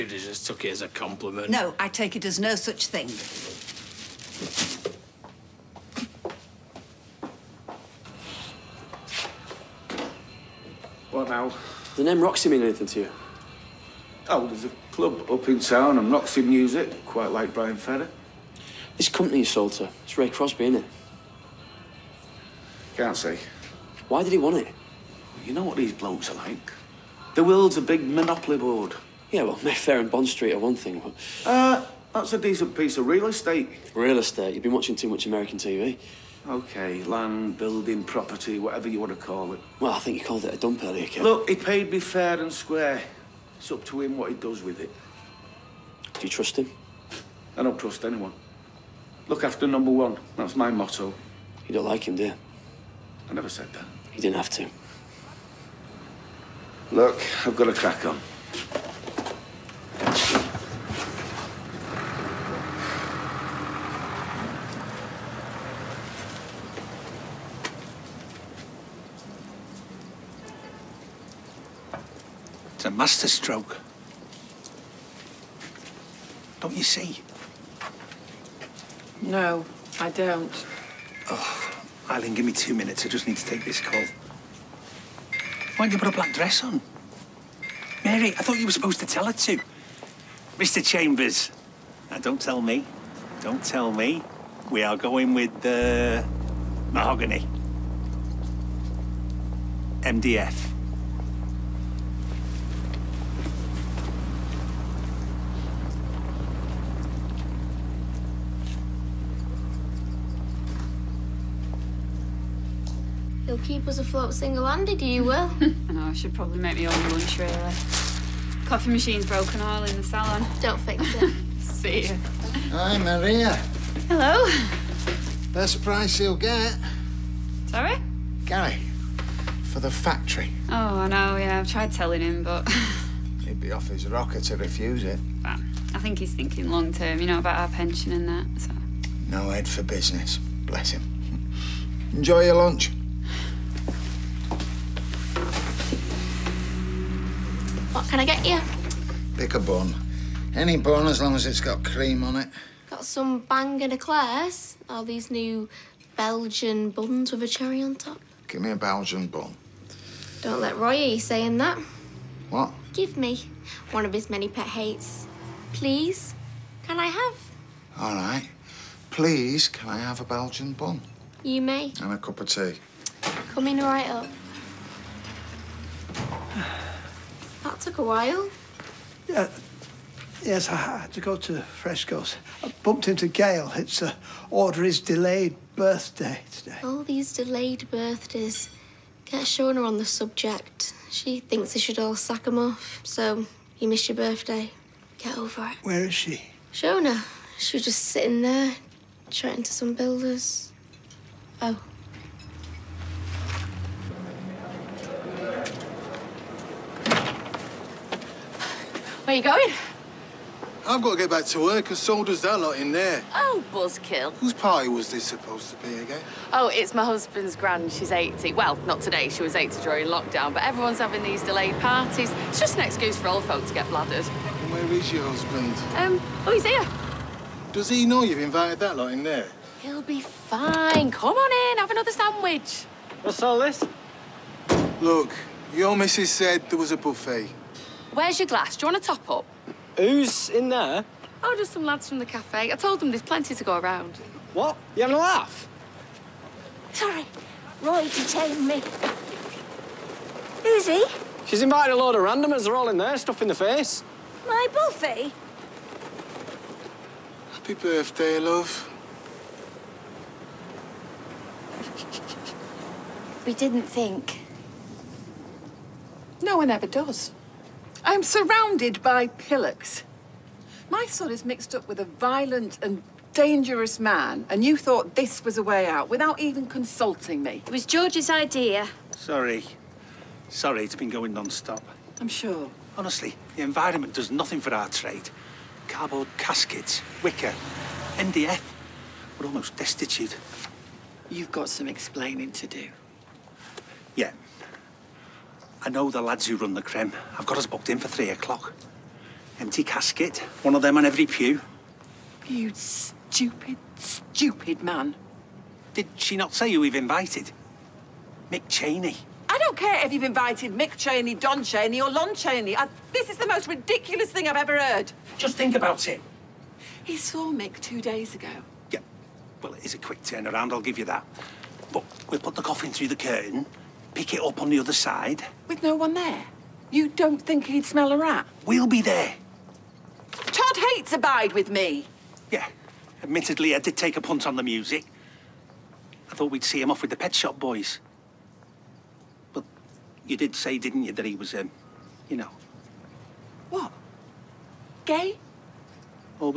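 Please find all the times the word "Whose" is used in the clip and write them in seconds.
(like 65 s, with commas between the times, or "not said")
214 s.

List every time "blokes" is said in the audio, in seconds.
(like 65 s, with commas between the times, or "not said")
25 s.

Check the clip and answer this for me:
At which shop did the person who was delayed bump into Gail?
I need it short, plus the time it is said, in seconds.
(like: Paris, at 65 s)
Freshco's, at 181 s.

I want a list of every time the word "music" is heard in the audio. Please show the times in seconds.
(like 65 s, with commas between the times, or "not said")
16 s, 334 s.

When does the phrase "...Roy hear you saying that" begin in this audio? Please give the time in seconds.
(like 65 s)
160 s.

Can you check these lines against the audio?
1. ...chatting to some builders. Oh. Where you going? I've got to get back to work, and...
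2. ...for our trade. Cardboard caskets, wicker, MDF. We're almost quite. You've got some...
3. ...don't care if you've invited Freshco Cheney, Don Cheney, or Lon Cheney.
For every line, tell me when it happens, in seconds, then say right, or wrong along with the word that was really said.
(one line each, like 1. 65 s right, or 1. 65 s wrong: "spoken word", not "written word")
1. 199 s right
2. 284 s wrong: "destitute", not "quite"
3. 309 s wrong: "Mick", not "Freshco".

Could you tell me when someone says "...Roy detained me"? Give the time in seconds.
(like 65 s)
247 s.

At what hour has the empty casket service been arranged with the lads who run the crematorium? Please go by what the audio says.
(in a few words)
3 o'clock.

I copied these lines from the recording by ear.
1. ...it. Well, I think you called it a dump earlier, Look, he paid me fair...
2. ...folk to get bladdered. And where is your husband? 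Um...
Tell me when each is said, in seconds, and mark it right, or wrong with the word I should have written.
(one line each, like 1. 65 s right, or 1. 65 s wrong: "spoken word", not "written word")
1. 39 s right
2. 223 s right.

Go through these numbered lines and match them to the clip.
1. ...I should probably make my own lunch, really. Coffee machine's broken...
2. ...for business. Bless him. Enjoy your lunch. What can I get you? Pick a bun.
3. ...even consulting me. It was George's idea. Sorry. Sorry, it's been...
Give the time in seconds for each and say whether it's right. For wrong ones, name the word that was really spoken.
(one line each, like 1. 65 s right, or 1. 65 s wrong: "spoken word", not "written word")
1. 116 s right
2. 139 s right
3. 276 s right.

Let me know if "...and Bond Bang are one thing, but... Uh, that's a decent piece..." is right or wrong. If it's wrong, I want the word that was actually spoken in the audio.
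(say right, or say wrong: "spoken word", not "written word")
wrong: "Street", not "Bang".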